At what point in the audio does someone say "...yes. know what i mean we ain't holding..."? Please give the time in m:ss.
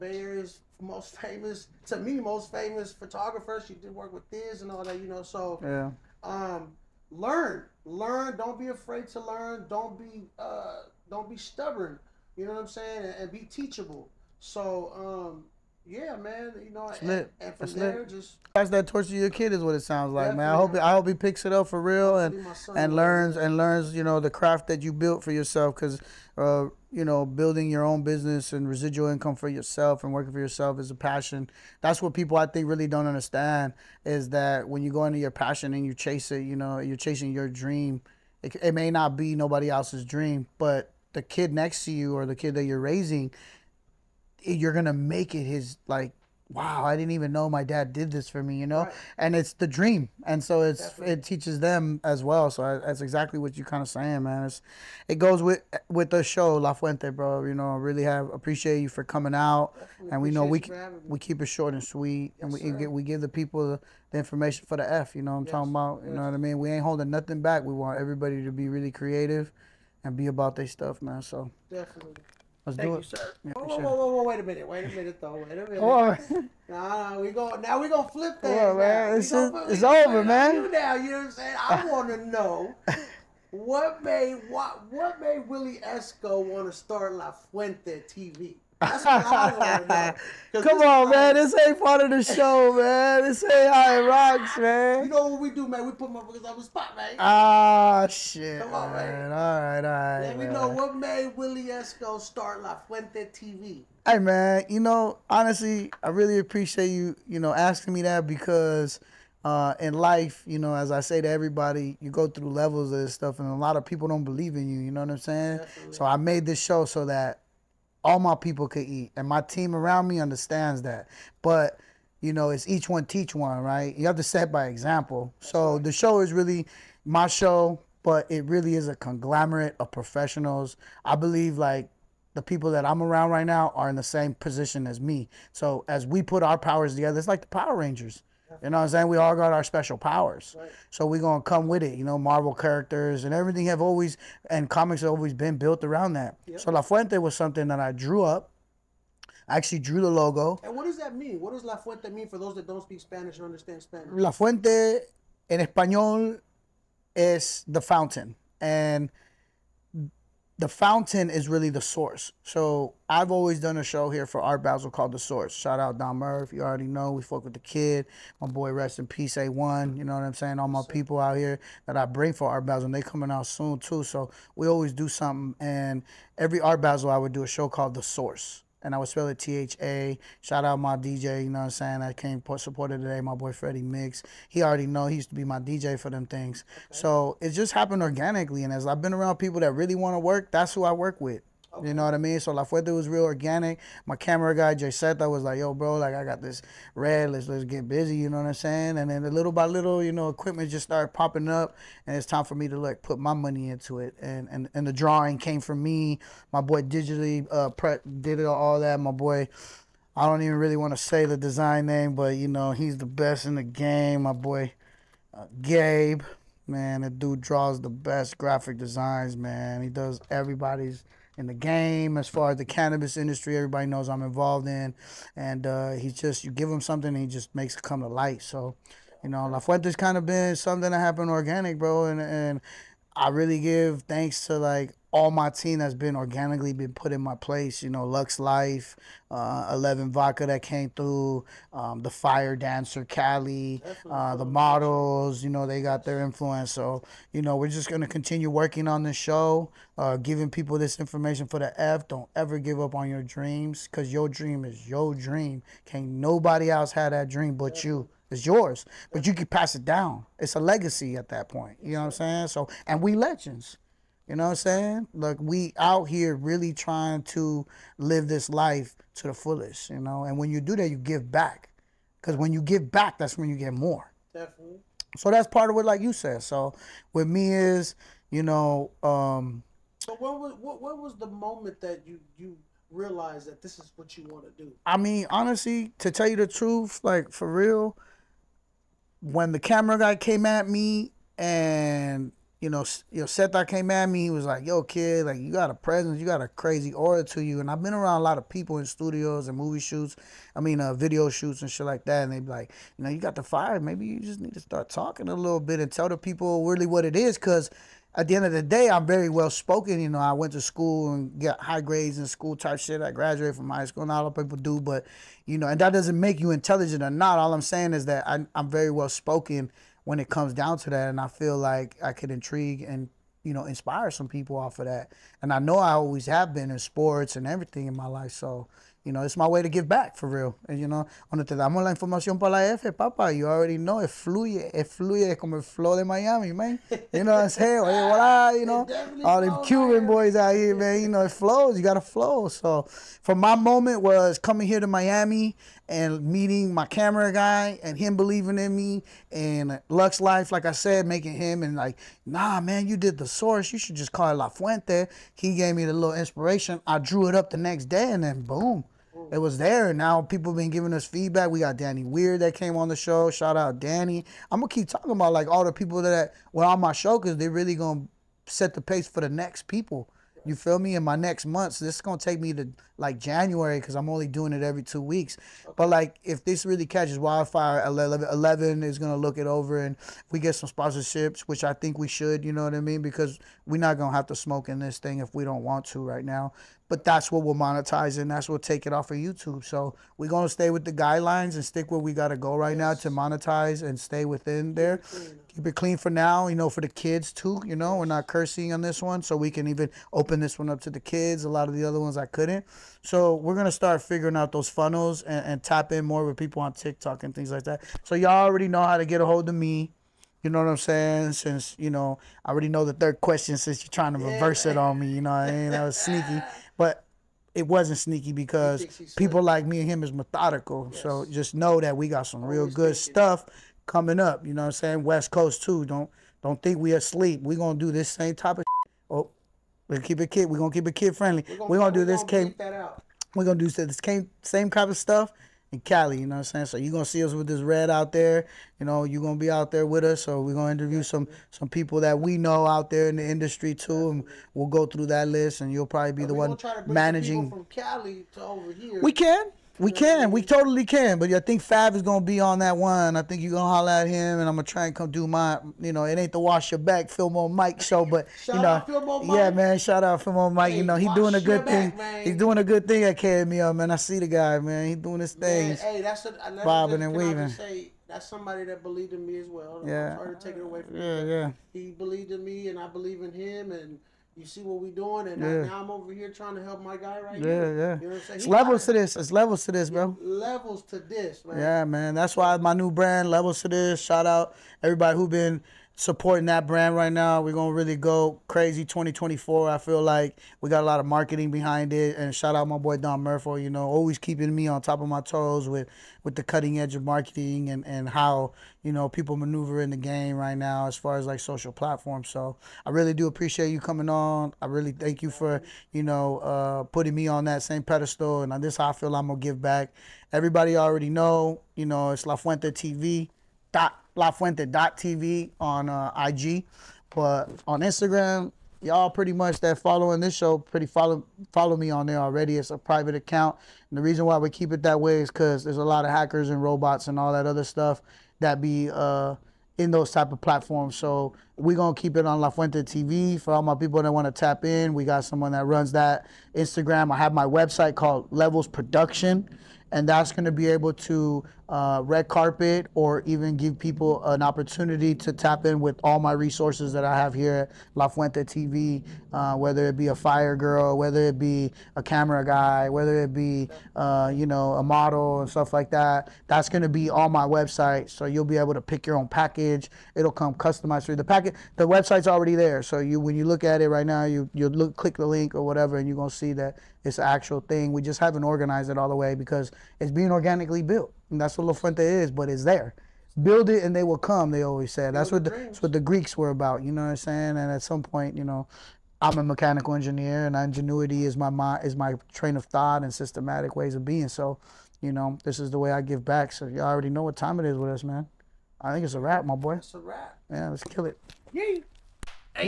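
1:06.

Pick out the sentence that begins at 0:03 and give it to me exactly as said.
She did work with this and all that, you know.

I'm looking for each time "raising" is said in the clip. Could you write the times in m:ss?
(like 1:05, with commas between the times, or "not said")
0:42.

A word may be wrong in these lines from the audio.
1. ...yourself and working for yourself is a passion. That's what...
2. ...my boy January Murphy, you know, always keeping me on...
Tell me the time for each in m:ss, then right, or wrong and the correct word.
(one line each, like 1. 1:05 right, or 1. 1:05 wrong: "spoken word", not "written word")
1. 0:29 right
2. 8:12 wrong: "Don", not "January".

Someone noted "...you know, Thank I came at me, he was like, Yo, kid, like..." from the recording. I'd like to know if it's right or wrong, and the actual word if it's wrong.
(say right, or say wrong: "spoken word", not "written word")
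wrong: "Seth", not "Thank".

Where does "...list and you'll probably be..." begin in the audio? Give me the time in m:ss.
7:25.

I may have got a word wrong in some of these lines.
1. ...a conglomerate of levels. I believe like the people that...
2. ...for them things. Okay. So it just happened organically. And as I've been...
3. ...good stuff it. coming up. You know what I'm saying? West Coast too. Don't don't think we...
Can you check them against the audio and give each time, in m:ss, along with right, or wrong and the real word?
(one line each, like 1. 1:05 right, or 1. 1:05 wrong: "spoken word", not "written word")
1. 2:08 wrong: "professionals", not "levels"
2. 3:05 right
3. 7:02 right.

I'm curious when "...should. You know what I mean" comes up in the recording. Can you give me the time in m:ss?
6:22.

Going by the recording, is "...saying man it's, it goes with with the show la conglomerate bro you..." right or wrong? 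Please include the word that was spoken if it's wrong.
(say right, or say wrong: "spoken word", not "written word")
wrong: "fuente", not "conglomerate".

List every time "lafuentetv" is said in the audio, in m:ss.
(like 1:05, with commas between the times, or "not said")
8:34.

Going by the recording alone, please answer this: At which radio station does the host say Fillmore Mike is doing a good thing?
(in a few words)
KMEL.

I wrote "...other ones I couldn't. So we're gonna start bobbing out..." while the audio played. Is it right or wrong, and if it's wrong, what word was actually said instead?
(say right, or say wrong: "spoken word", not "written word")
wrong: "figuring", not "bobbing".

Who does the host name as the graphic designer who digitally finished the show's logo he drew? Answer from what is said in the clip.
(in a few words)
Gabe.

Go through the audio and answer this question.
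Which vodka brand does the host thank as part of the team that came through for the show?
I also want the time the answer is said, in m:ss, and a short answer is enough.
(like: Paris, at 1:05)
Eleven Vodka, at 3:59.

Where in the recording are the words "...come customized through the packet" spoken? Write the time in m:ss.
9:20.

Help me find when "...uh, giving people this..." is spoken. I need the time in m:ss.
4:09.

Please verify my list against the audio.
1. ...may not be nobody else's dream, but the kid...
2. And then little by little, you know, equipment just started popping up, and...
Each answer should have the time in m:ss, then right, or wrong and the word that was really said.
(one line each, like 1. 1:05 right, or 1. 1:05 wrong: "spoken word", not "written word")
1. 0:38 right
2. 3:18 right.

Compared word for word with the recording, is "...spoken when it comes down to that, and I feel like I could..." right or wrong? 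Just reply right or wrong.
right.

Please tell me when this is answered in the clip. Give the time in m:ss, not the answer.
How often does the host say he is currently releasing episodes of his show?
6:14.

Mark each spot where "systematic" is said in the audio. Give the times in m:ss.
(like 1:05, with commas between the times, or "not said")
9:43.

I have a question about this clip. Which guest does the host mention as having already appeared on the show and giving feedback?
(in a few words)
Danny Weird.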